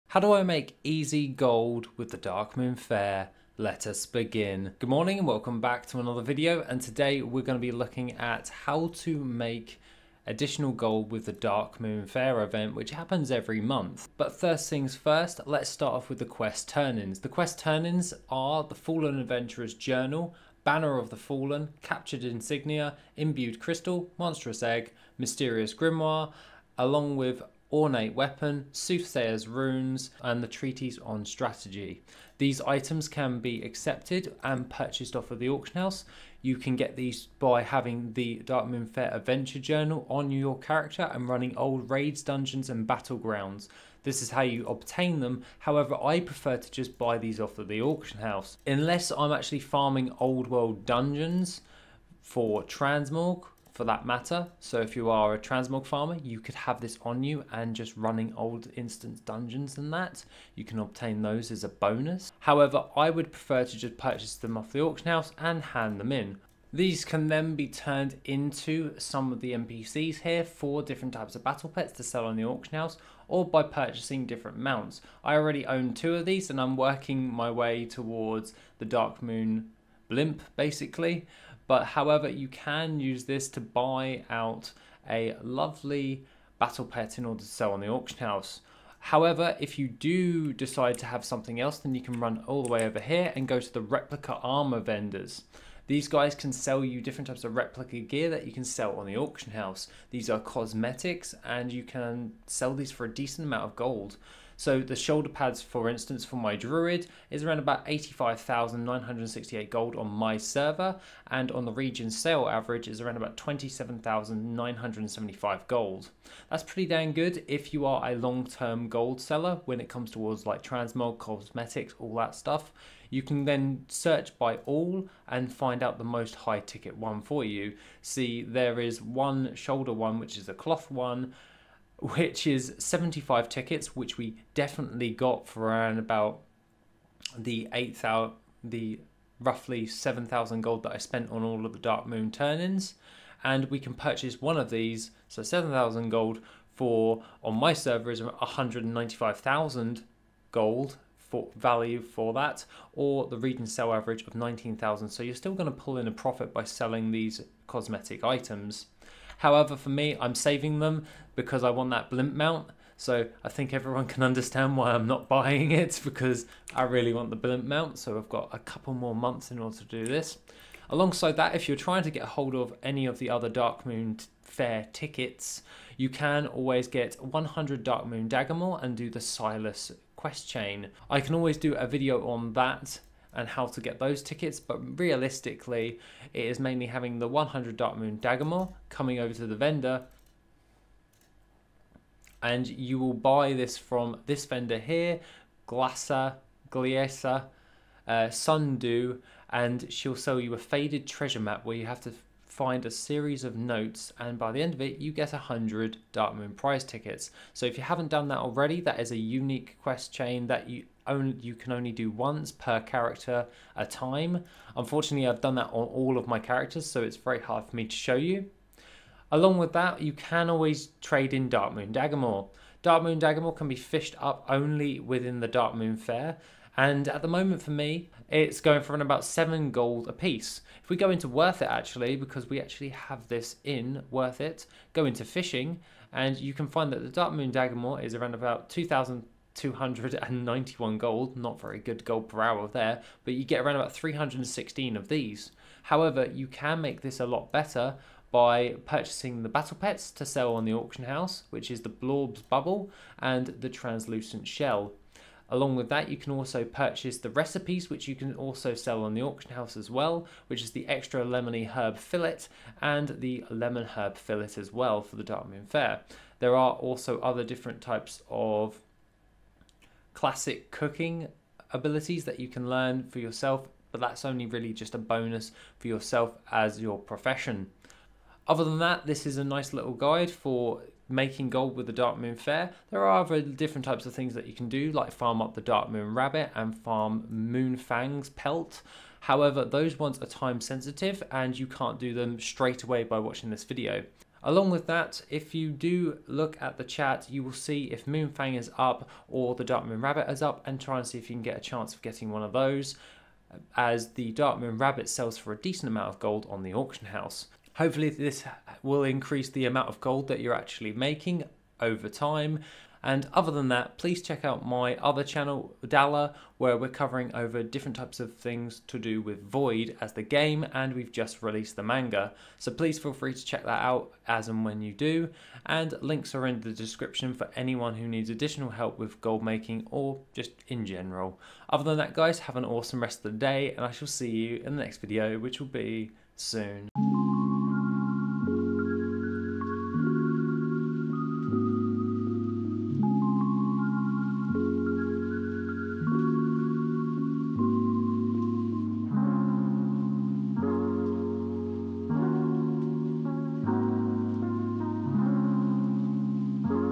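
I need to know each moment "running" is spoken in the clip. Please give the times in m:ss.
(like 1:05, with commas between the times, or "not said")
0:41, 0:57.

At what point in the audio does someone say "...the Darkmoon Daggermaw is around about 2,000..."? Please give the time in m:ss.
3:57.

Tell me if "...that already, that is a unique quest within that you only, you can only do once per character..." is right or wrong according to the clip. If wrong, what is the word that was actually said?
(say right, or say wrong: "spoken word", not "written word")
wrong: "chain", not "within".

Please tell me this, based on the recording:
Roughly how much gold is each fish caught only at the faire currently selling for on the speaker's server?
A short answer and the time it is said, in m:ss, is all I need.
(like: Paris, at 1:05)
7 gold, at 3:49.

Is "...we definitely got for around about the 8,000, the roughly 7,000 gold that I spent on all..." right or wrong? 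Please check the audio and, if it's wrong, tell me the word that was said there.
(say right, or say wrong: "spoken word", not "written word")
right.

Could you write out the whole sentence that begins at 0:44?
This is how you obtain them.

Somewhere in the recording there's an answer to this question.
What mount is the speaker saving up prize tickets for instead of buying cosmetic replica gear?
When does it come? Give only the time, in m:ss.
1:18.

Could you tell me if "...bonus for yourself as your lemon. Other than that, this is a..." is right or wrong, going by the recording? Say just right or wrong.
wrong.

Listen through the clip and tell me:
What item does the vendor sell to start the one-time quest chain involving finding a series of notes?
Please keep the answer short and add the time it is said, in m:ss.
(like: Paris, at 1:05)
Faded treasure map, at 3:20.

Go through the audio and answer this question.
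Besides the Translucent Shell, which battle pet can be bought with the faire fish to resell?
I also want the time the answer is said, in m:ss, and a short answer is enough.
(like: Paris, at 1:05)
Blorp's Bubble, at 4:11.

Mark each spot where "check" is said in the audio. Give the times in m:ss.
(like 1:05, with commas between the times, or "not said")
5:14, 5:23.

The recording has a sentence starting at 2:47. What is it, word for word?
So I've got a couple more months in order to do this.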